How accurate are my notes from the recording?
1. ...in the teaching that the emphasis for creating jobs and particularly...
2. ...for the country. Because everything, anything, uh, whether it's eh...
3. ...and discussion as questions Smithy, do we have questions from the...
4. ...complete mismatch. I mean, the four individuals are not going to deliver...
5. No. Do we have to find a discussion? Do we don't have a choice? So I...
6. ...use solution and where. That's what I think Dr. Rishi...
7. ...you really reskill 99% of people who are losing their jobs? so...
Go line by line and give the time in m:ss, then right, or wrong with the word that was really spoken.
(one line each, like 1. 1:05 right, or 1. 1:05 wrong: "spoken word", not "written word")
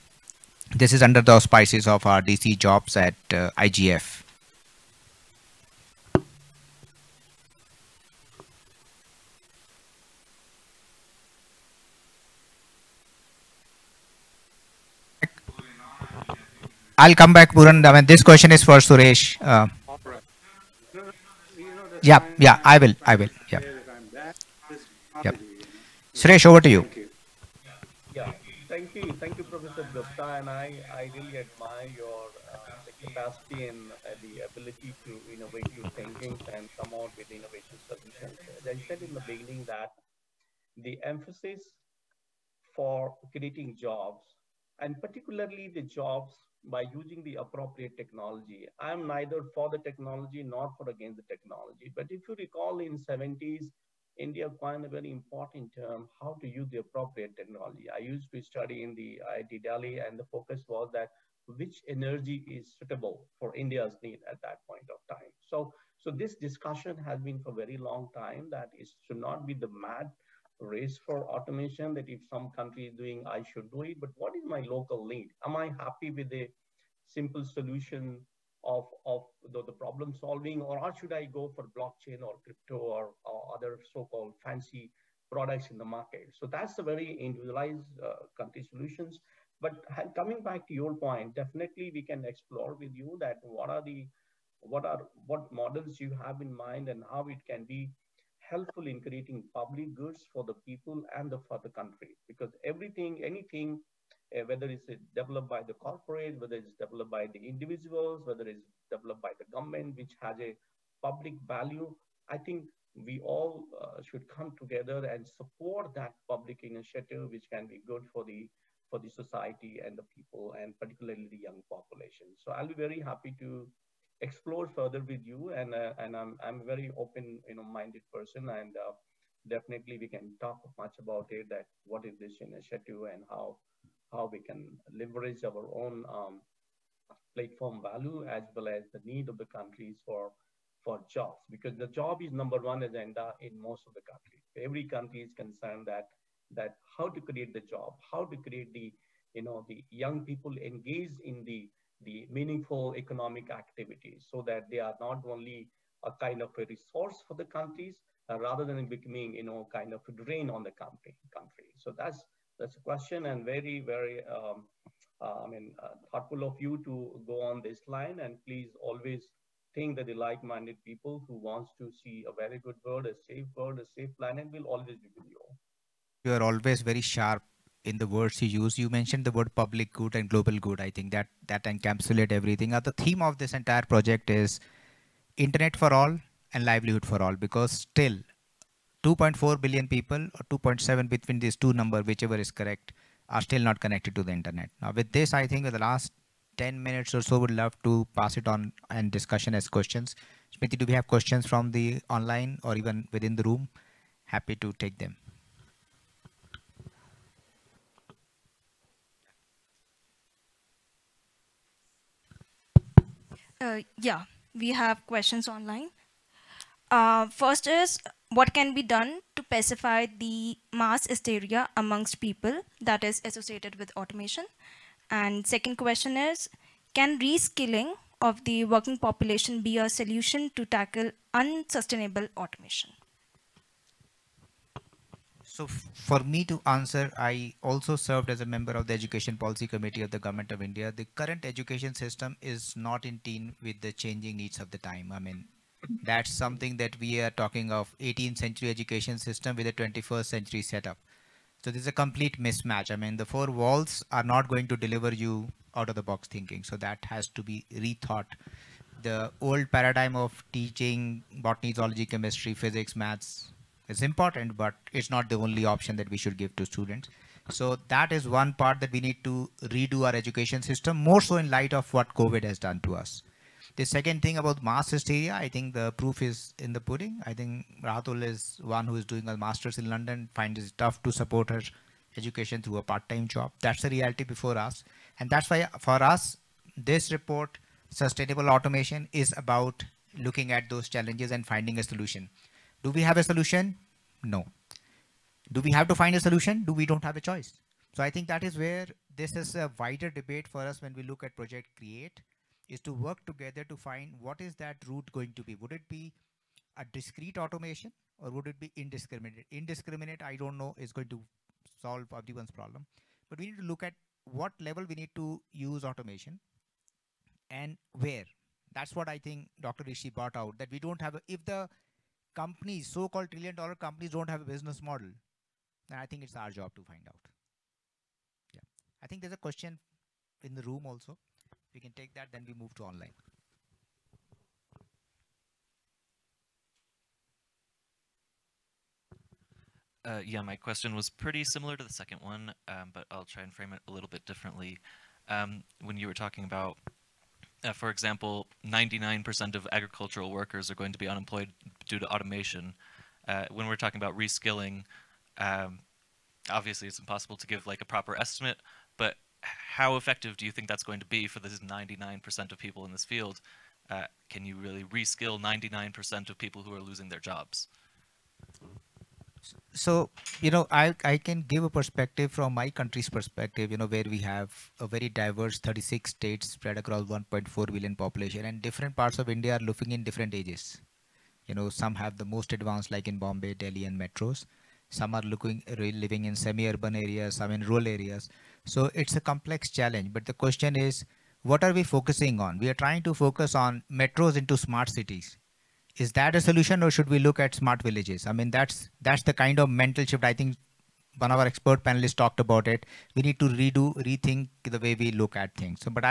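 1. 0:39 wrong: "beginning", not "teaching"
2. 1:41 right
3. 3:18 right
4. 4:11 wrong: "walls", not "individuals"
5. 4:54 wrong: "solution", not "discussion"
6. 5:15 wrong: "automation", not "solution"
7. 6:04 right.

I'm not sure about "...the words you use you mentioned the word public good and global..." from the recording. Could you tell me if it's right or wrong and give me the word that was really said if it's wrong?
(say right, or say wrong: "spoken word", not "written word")
right.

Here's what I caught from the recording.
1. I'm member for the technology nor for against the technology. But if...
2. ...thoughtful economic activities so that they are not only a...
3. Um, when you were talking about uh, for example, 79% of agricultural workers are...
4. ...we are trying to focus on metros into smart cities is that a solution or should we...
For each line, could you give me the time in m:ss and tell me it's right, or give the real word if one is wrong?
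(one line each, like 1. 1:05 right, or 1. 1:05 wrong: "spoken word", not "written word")
1. 0:48 wrong: "neither", not "member"
2. 2:32 wrong: "meaningful", not "thoughtful"
3. 5:45 wrong: "99", not "79"
4. 6:32 right.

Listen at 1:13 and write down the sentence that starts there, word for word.
But what is my local need?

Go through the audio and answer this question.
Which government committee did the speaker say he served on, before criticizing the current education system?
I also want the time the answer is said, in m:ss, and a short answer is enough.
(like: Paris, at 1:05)
Education Policy Committee, at 3:58.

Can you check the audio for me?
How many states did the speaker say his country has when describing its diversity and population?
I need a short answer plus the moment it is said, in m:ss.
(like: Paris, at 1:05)
36, at 6:15.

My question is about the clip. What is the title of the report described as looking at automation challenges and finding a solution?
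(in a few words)
Sustainable Automation.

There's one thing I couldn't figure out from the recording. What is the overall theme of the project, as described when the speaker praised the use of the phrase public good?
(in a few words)
Internet for all and livelihood for all.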